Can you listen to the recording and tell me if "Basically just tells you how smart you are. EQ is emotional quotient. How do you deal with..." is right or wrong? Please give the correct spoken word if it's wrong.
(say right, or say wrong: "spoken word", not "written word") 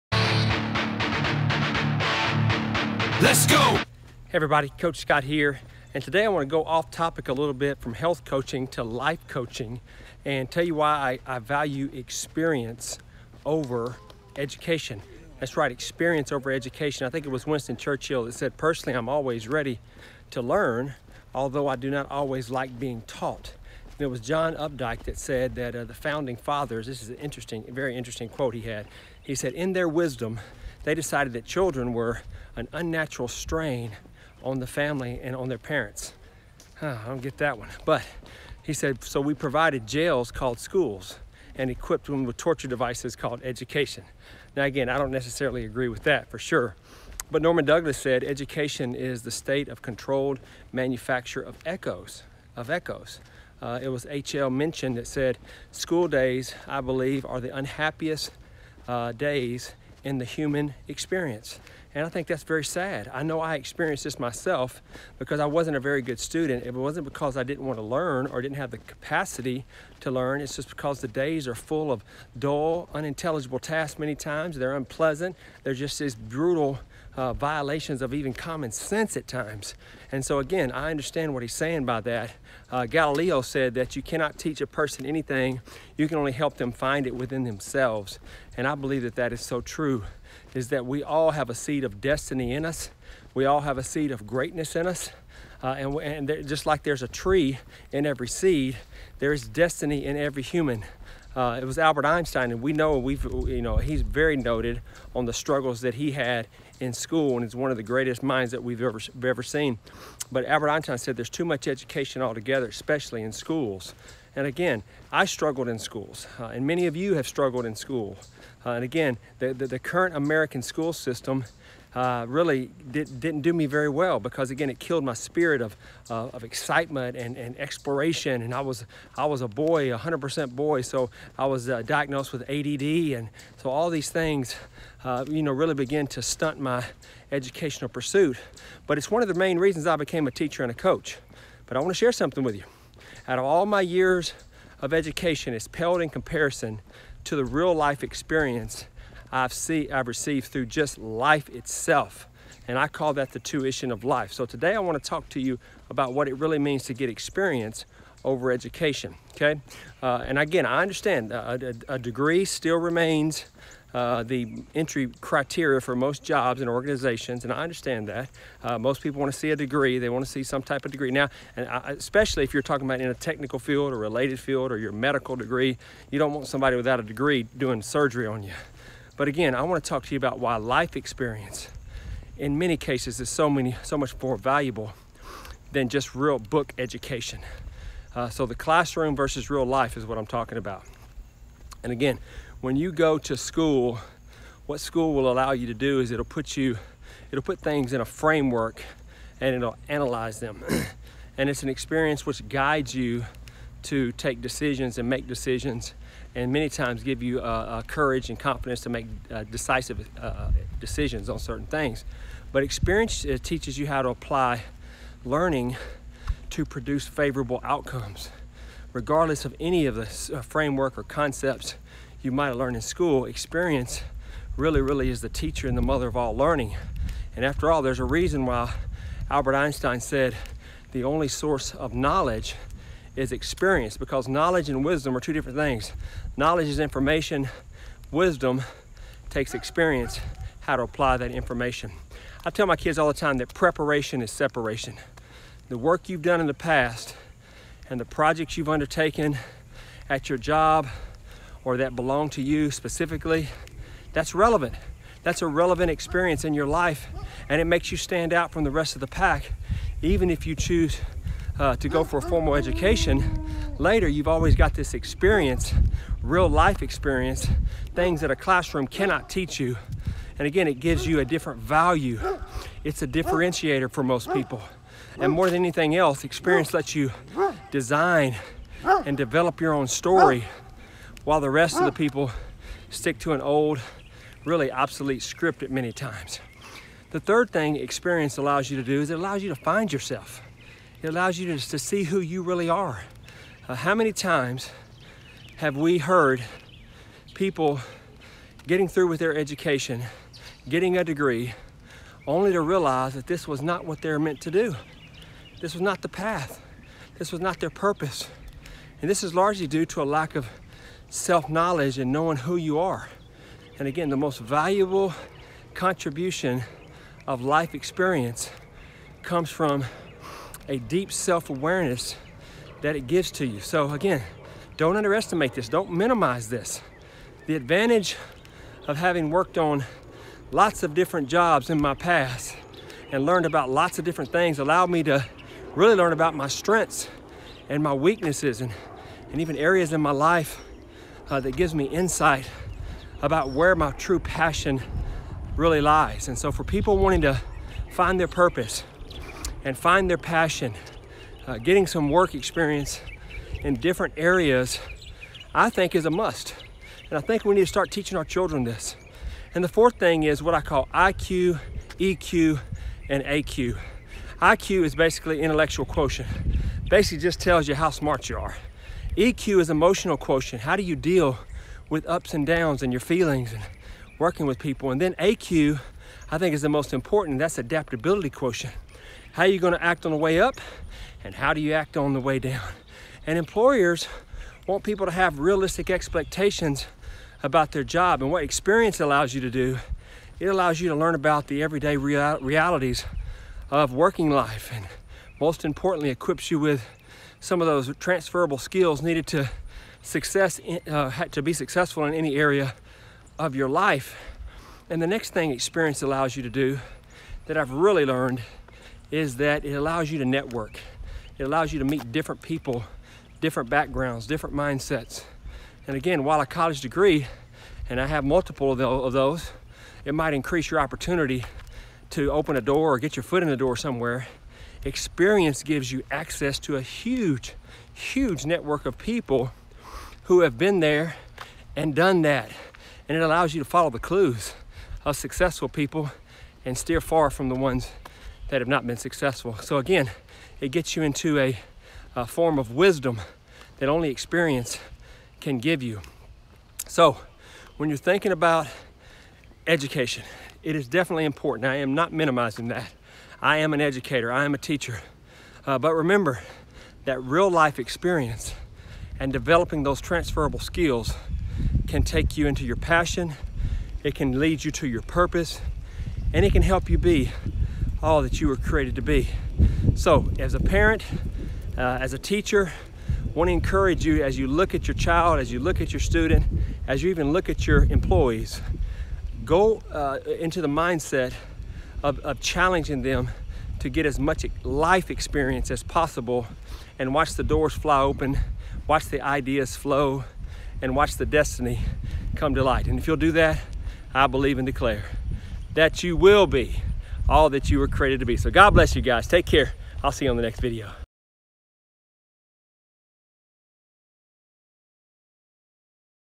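right.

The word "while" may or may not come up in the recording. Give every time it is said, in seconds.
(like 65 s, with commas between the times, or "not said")
281 s, 416 s.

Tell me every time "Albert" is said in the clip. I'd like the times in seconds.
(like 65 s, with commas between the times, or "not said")
101 s, 110 s, 229 s.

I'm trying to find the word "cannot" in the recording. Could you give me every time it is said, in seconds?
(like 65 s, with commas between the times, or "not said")
84 s, 268 s.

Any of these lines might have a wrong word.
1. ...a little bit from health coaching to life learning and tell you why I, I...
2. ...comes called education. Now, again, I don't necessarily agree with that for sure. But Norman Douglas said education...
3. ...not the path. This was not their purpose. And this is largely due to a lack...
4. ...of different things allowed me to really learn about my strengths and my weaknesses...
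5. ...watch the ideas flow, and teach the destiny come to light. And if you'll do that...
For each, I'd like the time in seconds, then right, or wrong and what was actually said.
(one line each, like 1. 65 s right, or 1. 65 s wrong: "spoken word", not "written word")
1. 7 s wrong: "coaching", not "learning"
2. 42 s wrong: "devices", not "comes"
3. 305 s right
4. 333 s right
5. 488 s wrong: "watch", not "teach".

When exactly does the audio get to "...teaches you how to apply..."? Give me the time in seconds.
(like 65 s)
213 s.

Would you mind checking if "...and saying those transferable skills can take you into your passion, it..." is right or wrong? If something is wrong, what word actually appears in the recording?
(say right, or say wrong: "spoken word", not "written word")
wrong: "developing", not "saying".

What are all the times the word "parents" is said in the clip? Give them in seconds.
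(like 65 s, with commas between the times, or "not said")
35 s, 470 s.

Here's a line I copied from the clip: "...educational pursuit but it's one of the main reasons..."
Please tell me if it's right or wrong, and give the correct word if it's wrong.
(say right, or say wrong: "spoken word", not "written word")
right.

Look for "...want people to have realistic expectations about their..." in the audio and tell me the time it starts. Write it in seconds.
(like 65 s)
384 s.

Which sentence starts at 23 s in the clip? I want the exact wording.
And it was John Updike that said that uh, the founding fathers, this is an interesting, very interesting quote he had.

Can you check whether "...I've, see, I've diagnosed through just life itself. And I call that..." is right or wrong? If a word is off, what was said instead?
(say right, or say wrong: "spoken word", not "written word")
wrong: "received", not "diagnosed".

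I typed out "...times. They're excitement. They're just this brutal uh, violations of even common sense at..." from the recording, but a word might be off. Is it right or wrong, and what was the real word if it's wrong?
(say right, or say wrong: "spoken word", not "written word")
wrong: "unpleasant", not "excitement".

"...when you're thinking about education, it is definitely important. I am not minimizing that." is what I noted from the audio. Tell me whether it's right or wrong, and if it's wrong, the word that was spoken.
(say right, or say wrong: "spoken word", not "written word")
right.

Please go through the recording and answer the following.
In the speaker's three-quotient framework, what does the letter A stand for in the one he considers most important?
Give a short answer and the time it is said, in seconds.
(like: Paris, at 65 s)
adaptability, at 377 s.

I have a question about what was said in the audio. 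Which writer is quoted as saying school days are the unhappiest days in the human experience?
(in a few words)
H.L. Mencken.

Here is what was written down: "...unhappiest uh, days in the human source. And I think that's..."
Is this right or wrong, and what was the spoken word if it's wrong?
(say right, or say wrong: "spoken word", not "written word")
wrong: "experience", not "source".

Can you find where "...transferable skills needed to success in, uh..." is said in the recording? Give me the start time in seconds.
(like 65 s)
397 s.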